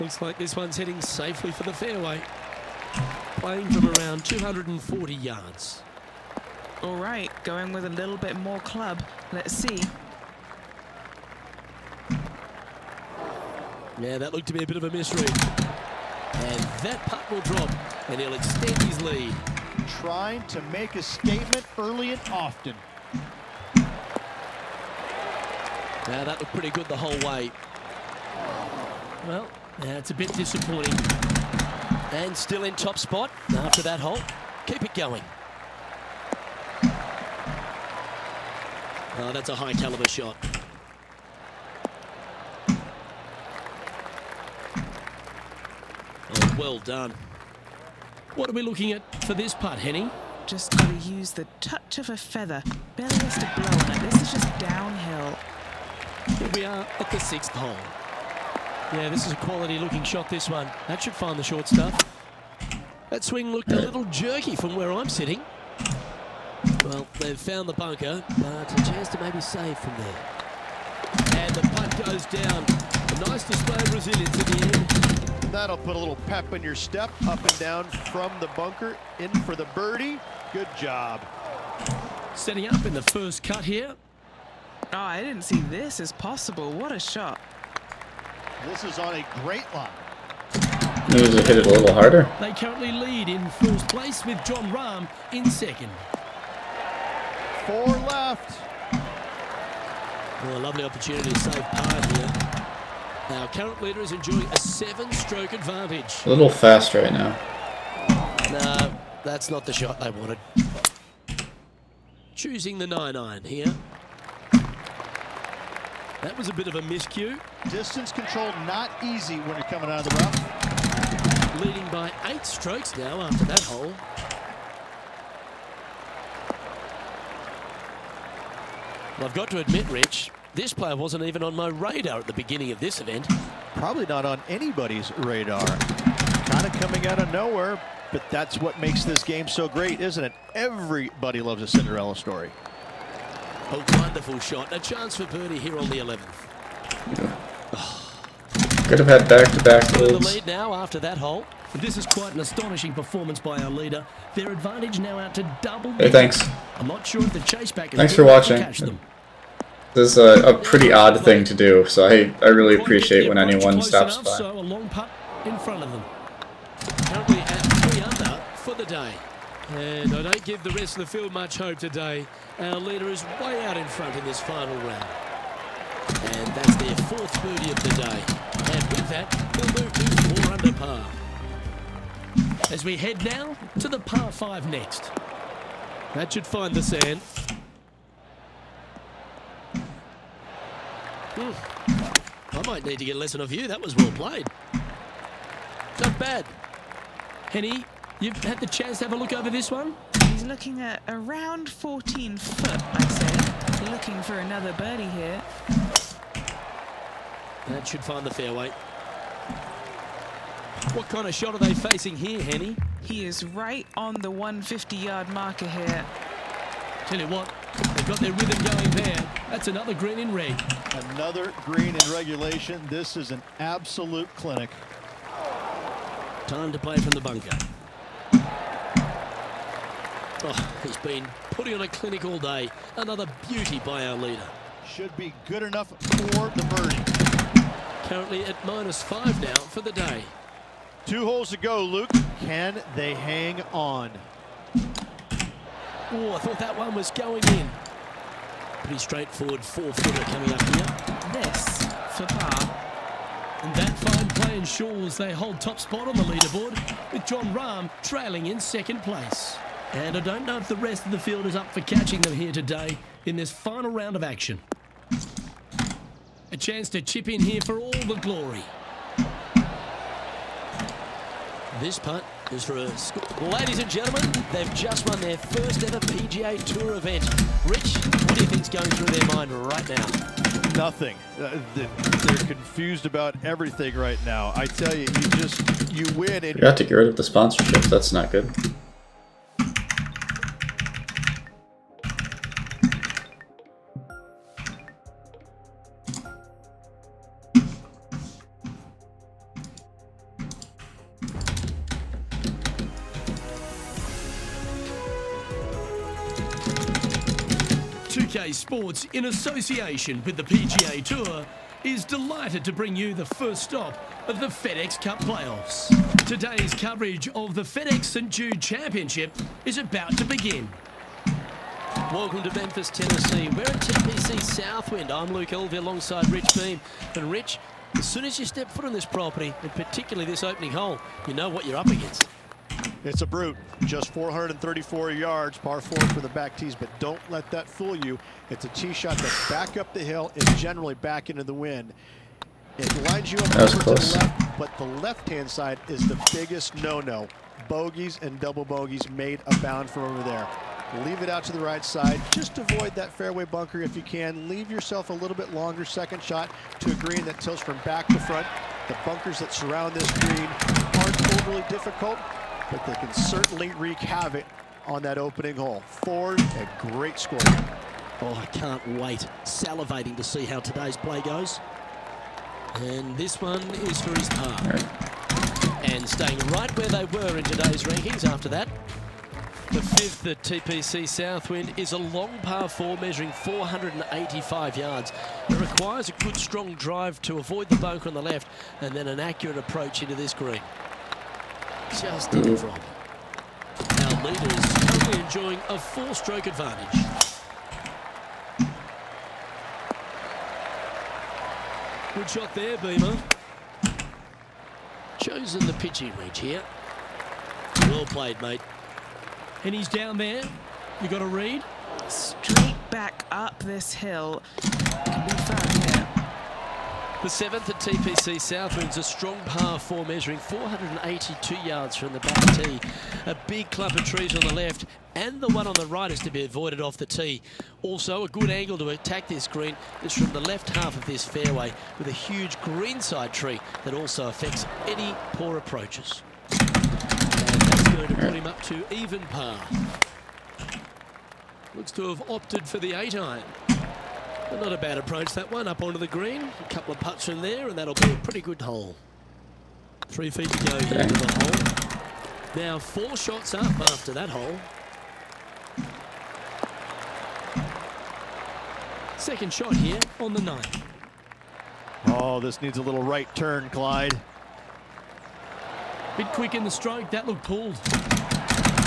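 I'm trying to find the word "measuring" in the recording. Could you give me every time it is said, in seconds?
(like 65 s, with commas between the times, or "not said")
382 s, 420 s.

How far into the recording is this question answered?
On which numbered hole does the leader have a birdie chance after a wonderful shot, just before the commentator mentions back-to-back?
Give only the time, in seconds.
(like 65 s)
145 s.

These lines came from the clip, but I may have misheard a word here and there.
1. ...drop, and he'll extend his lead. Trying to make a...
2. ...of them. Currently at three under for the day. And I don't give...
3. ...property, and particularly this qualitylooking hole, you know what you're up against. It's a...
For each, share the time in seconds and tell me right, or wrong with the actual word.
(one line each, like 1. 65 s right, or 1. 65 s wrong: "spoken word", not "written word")
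1. 17 s right
2. 165 s right
3. 329 s wrong: "opening", not "qualitylooking".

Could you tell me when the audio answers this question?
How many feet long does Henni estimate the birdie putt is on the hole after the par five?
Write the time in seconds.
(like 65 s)
201 s.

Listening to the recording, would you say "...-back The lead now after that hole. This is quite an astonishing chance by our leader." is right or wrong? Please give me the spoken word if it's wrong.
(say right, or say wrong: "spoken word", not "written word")
wrong: "performance", not "chance".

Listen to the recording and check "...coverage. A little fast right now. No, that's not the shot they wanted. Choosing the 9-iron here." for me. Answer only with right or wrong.
wrong.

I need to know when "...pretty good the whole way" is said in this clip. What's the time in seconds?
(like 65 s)
26 s.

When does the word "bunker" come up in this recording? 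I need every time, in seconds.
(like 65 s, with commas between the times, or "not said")
67 s, 78 s, 227 s, 353 s, 359 s, 387 s.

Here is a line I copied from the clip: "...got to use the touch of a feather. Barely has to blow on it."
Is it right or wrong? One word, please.
right.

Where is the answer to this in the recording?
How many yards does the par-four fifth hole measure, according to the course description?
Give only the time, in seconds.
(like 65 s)
383 s.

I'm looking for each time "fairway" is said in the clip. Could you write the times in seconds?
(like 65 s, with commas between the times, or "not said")
1 s, 208 s, 353 s, 431 s.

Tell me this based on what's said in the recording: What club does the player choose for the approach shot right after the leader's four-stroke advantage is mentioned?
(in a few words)
Pitching wedge.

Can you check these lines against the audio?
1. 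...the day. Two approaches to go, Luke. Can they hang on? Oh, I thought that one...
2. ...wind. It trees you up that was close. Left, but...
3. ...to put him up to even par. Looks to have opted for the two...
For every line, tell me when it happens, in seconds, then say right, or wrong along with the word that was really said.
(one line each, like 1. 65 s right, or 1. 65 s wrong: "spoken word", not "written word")
1. 239 s wrong: "holes", not "approaches"
2. 341 s wrong: "lines", not "trees"
3. 438 s wrong: "eight", not "two".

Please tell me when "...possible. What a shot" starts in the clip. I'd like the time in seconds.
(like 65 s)
86 s.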